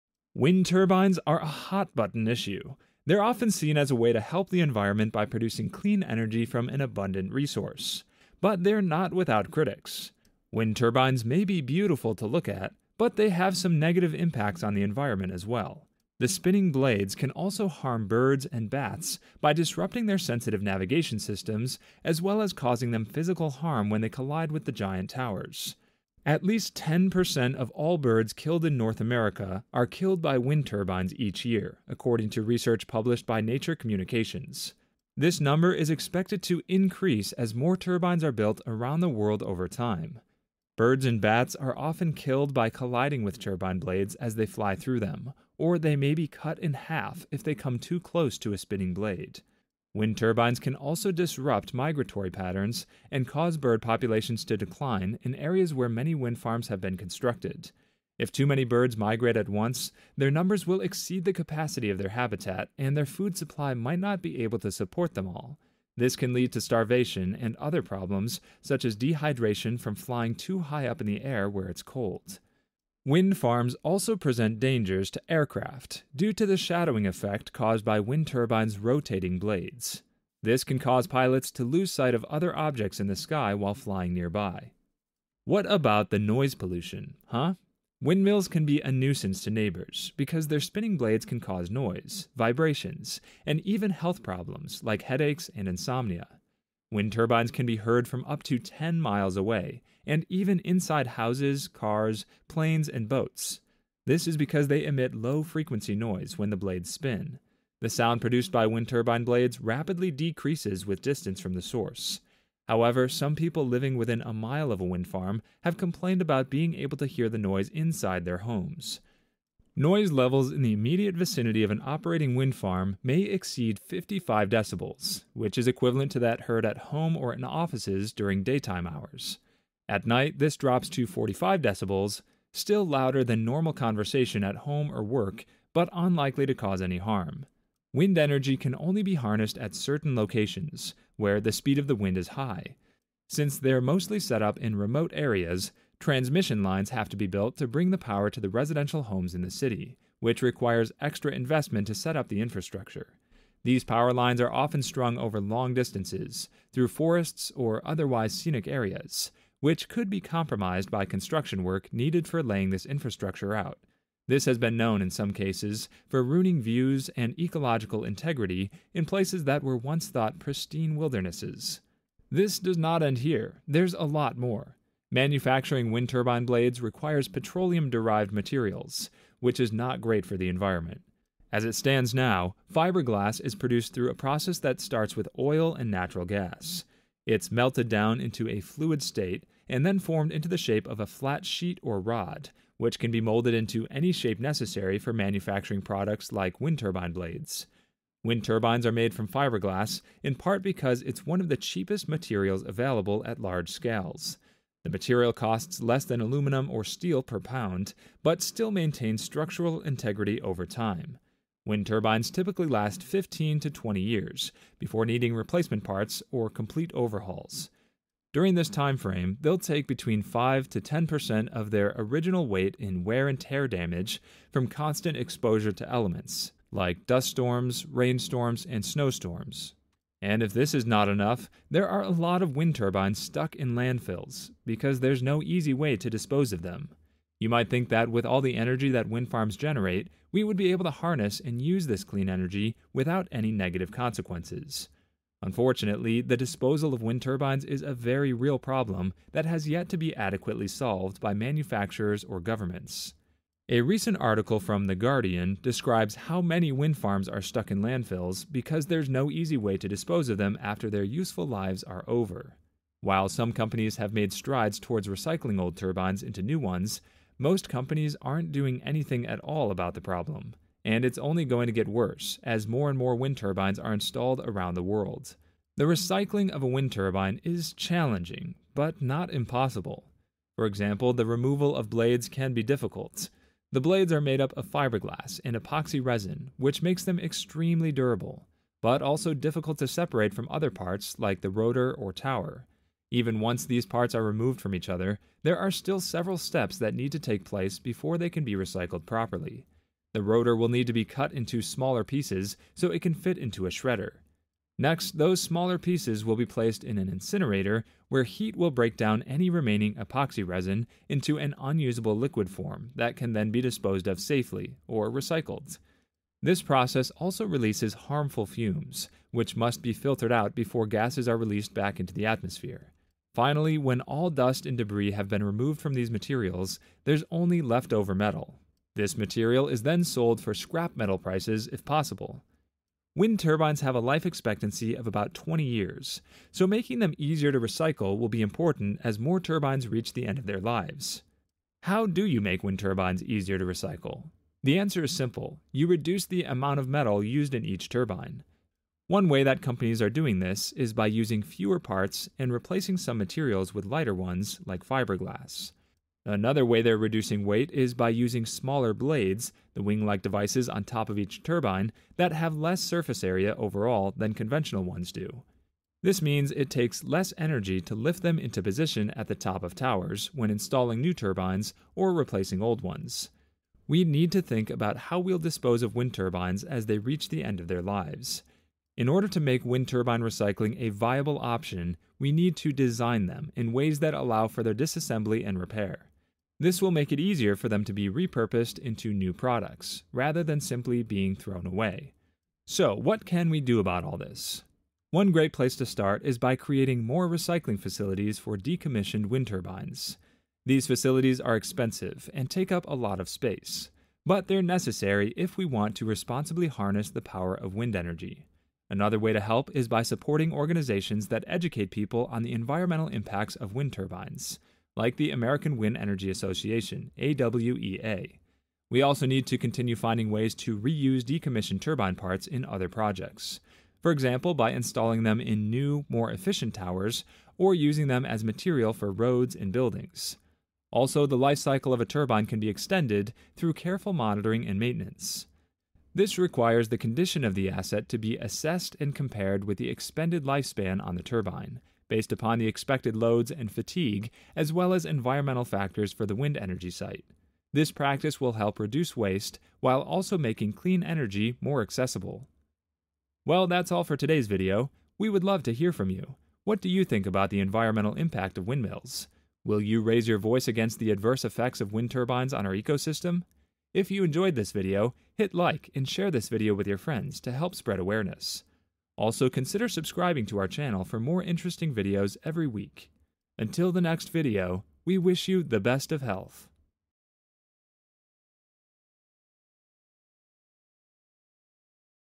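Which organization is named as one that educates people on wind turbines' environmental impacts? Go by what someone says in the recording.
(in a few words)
American Wind Energy Association.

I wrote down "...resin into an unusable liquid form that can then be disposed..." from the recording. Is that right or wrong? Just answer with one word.
right.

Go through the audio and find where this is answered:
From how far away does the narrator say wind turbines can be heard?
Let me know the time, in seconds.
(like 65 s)
98 s.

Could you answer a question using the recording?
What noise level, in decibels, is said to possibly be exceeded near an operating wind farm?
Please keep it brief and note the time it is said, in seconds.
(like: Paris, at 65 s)
55, at 123 s.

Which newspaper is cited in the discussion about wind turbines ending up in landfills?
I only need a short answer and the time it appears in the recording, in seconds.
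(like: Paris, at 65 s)
The Guardian, at 254 s.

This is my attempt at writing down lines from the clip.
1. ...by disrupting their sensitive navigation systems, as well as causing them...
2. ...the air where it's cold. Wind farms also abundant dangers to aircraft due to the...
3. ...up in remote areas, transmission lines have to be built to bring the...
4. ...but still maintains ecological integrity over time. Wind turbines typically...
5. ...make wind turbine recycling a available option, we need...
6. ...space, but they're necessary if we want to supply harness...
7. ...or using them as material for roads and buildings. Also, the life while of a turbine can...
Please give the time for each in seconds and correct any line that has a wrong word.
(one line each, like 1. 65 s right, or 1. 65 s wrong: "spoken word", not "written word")
1. 19 s right
2. 71 s wrong: "present", not "abundant"
3. 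144 s right
4. 208 s wrong: "structural", not "ecological"
5. 379 s wrong: "viable", not "available"
6. 403 s wrong: "responsibly", not "supply"
7. 427 s wrong: "cycle", not "while".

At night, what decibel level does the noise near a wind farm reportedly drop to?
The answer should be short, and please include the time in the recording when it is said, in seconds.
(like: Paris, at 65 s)
45, at 131 s.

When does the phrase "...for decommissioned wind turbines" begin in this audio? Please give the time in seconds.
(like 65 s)
398 s.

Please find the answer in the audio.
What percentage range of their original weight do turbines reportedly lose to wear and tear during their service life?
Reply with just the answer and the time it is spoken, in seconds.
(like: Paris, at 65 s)
5 to 10%, at 220 s.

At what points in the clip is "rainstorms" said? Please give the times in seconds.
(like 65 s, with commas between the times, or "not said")
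227 s.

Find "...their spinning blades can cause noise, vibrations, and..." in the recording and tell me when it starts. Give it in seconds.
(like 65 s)
90 s.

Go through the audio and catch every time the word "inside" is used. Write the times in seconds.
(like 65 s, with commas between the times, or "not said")
100 s, 117 s.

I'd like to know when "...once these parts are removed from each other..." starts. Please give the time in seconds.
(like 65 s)
293 s.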